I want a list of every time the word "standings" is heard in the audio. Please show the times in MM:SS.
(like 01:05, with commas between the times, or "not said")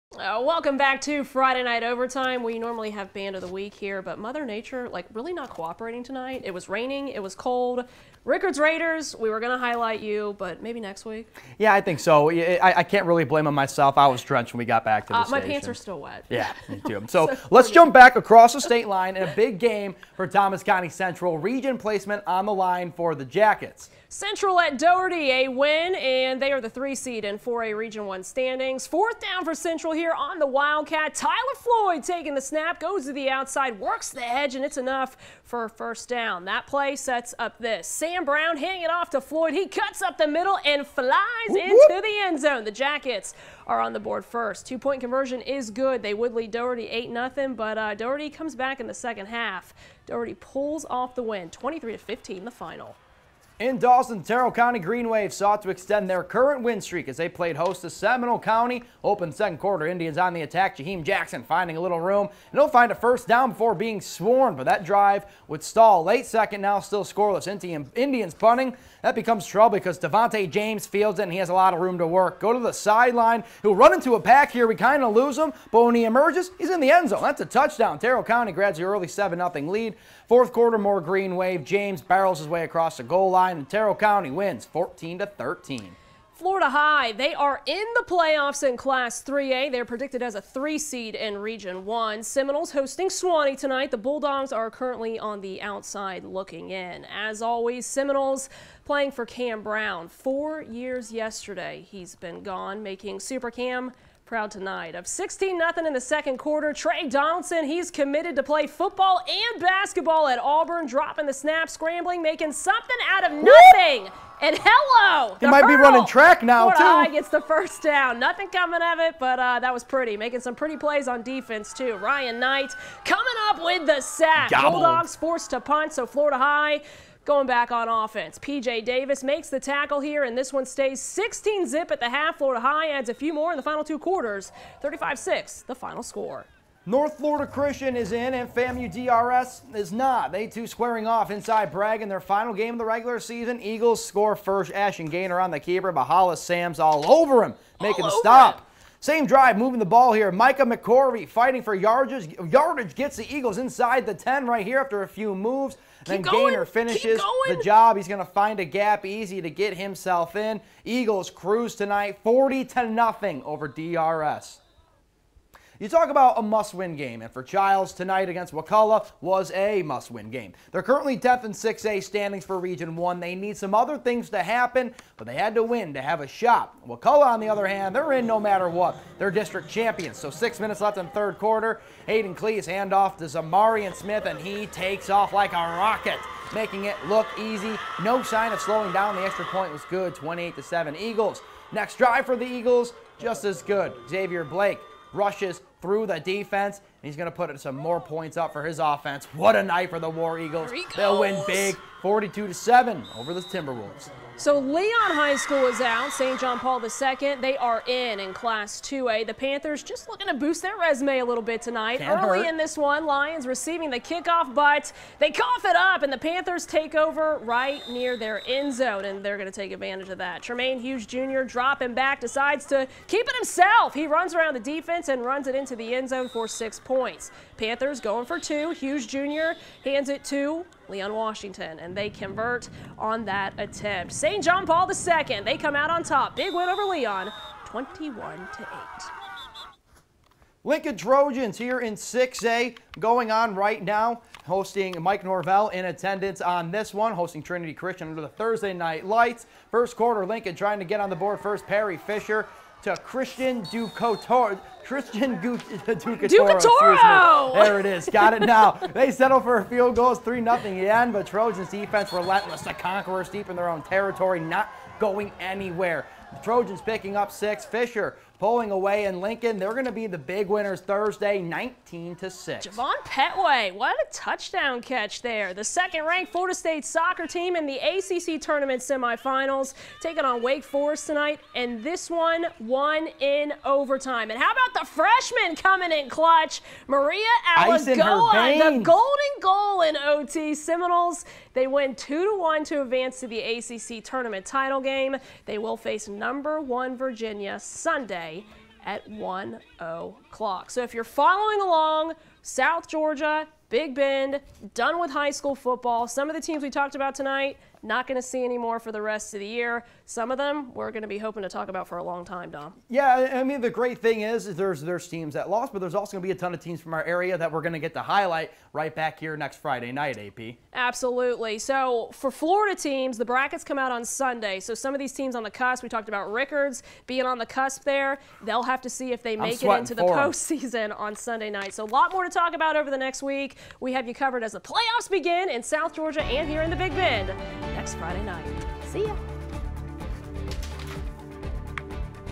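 00:28, 02:52.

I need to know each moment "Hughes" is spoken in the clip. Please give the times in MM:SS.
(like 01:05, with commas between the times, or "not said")
03:40, 03:48.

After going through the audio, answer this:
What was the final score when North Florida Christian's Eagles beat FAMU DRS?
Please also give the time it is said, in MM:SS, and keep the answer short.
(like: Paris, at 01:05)
40-0, at 02:42.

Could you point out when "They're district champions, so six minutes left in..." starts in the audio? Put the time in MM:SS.
02:59.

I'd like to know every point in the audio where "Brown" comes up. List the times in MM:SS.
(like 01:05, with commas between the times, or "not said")
00:38, 01:39.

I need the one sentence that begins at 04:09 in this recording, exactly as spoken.
First quarter, Lincoln trying to get on the board first.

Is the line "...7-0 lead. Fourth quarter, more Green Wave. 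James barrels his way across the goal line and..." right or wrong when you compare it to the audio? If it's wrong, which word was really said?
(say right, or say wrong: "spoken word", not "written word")
right.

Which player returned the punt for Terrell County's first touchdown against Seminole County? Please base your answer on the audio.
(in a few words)
Devontae James.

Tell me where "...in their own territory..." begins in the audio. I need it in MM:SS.
04:23.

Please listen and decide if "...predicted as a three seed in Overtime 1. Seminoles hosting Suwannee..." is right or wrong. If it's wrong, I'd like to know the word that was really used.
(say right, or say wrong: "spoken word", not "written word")
wrong: "Region", not "Overtime".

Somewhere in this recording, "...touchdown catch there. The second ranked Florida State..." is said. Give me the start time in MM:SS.
04:34.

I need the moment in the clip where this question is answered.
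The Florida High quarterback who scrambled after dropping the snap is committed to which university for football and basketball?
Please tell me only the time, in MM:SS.
01:50.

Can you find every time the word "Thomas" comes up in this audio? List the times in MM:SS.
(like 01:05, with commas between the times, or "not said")
00:20.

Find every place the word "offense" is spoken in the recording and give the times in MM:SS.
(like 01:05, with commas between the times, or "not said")
02:07, 03:18.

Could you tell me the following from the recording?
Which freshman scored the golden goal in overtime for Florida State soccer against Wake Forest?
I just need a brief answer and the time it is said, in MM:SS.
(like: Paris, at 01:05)
Maria Alagoa, at 04:46.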